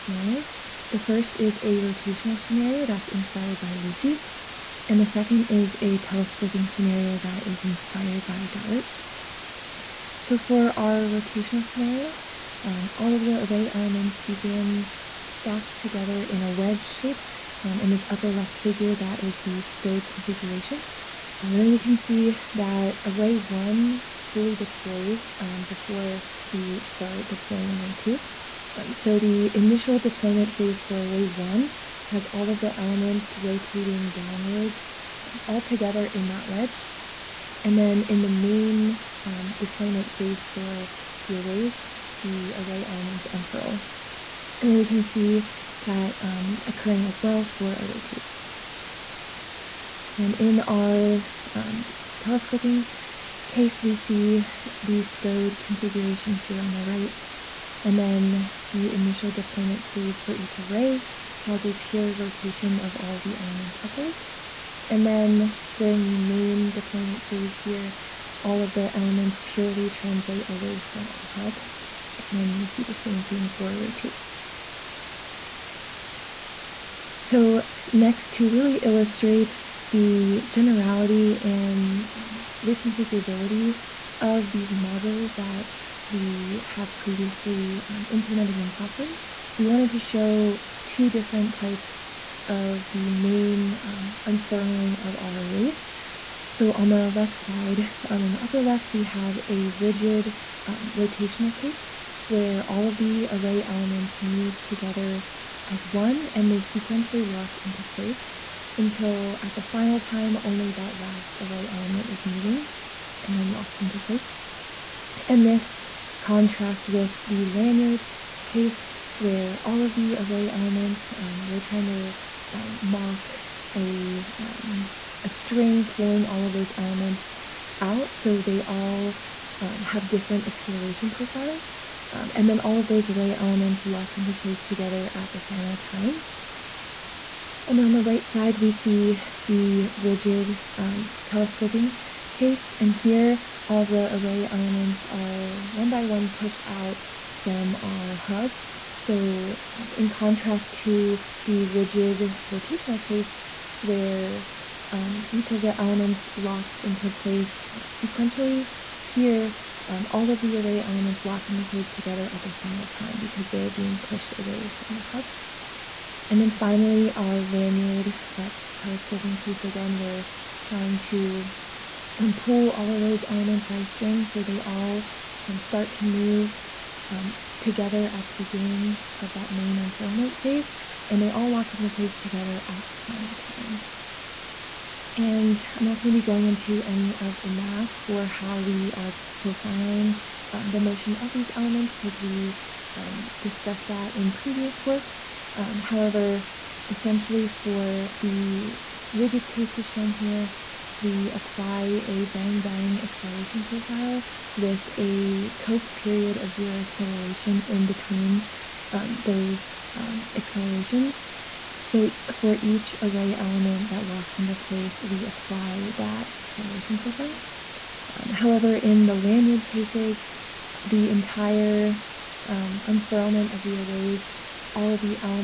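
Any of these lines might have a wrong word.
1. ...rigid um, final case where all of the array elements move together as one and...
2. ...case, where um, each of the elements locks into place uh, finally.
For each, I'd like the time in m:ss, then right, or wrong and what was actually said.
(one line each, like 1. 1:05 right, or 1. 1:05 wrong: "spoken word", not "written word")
1. 1:39 wrong: "rotational", not "final"
2. 2:33 wrong: "sequentially", not "finally".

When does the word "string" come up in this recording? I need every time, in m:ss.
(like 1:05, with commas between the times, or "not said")
2:05, 2:53.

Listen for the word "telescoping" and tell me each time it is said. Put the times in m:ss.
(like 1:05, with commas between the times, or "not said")
0:05, 0:52, 2:21, 2:48.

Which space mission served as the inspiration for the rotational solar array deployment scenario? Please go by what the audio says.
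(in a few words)
Lucy.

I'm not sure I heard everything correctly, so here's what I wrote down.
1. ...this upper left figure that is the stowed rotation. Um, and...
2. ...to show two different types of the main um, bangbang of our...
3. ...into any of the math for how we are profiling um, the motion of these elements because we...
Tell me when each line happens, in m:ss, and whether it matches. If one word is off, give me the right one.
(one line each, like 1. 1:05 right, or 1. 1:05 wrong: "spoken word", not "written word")
1. 0:17 wrong: "configuration", not "rotation"
2. 1:29 wrong: "unfurling", not "bangbang"
3. 3:06 right.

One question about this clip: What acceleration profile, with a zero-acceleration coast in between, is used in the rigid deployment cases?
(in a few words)
Bang-bang.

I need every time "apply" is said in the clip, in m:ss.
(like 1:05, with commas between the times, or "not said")
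3:21, 3:35.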